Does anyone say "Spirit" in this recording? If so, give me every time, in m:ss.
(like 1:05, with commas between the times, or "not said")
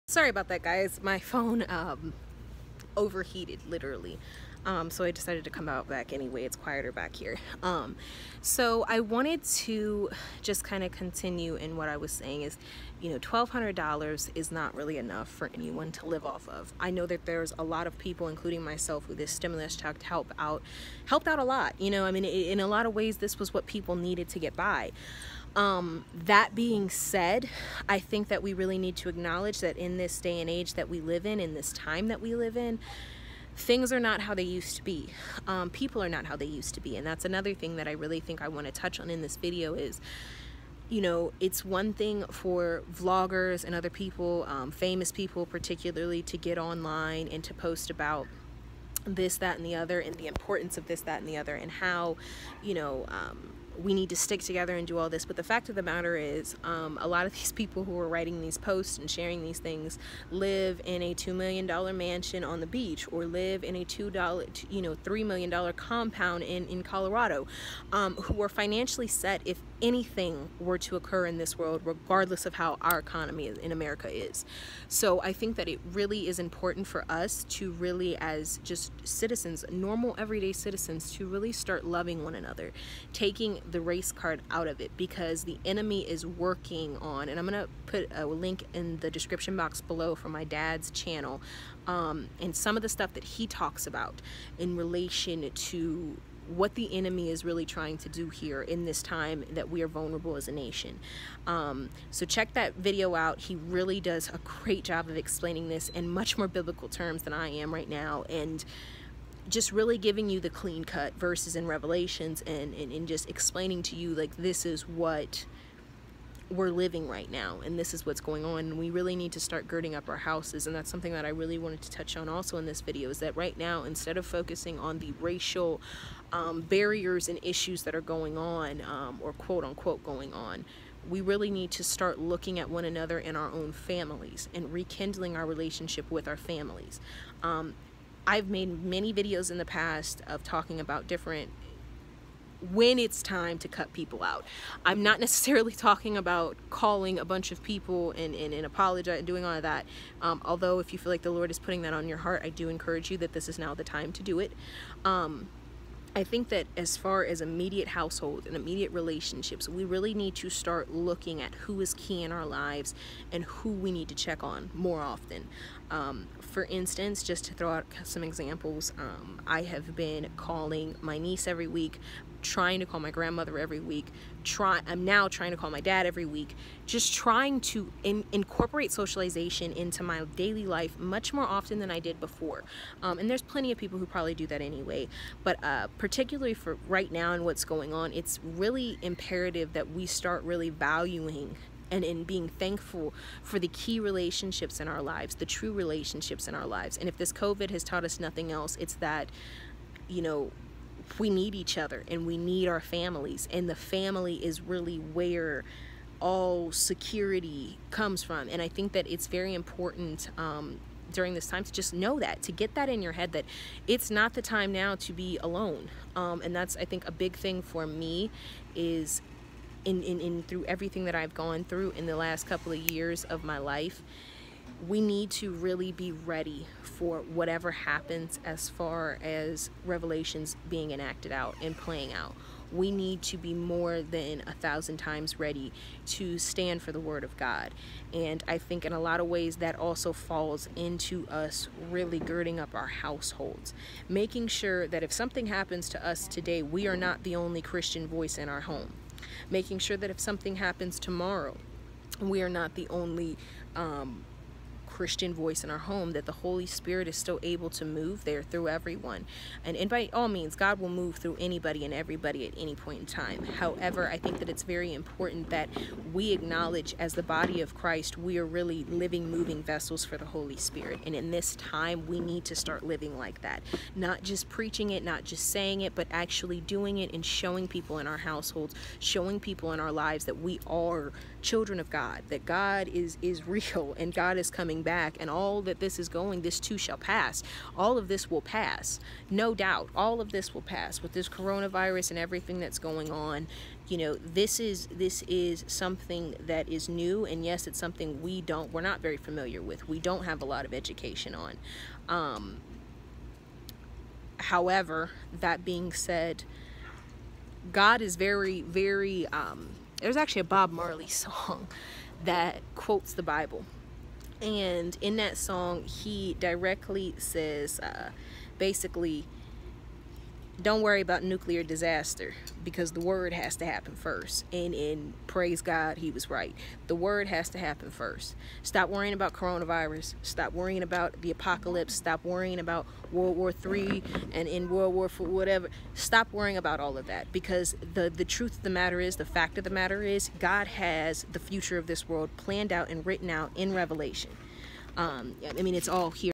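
4:16, 4:30.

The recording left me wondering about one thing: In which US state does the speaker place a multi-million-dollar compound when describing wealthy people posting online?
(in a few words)
Colorado.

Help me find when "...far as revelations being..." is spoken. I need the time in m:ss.
3:48.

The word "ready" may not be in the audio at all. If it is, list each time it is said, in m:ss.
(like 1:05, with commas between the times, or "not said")
3:46, 3:55.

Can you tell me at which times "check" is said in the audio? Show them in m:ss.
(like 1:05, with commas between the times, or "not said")
0:19, 1:42, 2:44.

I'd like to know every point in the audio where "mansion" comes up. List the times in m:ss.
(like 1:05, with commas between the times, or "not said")
1:01.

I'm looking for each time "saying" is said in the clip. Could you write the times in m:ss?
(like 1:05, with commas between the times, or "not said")
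0:12, 4:35.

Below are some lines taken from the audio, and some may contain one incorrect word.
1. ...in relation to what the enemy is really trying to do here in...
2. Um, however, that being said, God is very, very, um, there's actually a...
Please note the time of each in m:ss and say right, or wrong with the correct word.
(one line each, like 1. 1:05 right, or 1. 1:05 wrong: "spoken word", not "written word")
1. 1:34 right
2. 5:02 right.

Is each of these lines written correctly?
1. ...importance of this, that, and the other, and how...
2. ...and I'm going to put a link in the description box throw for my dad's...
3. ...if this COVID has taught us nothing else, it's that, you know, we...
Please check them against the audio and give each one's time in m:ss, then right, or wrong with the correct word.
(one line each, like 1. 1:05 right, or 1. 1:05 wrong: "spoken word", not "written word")
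1. 0:50 right
2. 1:27 wrong: "below", not "throw"
3. 3:17 right.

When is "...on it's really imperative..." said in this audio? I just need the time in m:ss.
3:07.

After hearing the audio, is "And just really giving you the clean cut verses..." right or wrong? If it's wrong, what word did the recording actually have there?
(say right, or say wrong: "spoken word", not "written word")
right.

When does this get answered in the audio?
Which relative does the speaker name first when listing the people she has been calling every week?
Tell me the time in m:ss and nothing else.
2:51.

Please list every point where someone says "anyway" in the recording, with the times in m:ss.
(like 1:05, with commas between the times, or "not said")
0:06, 3:04.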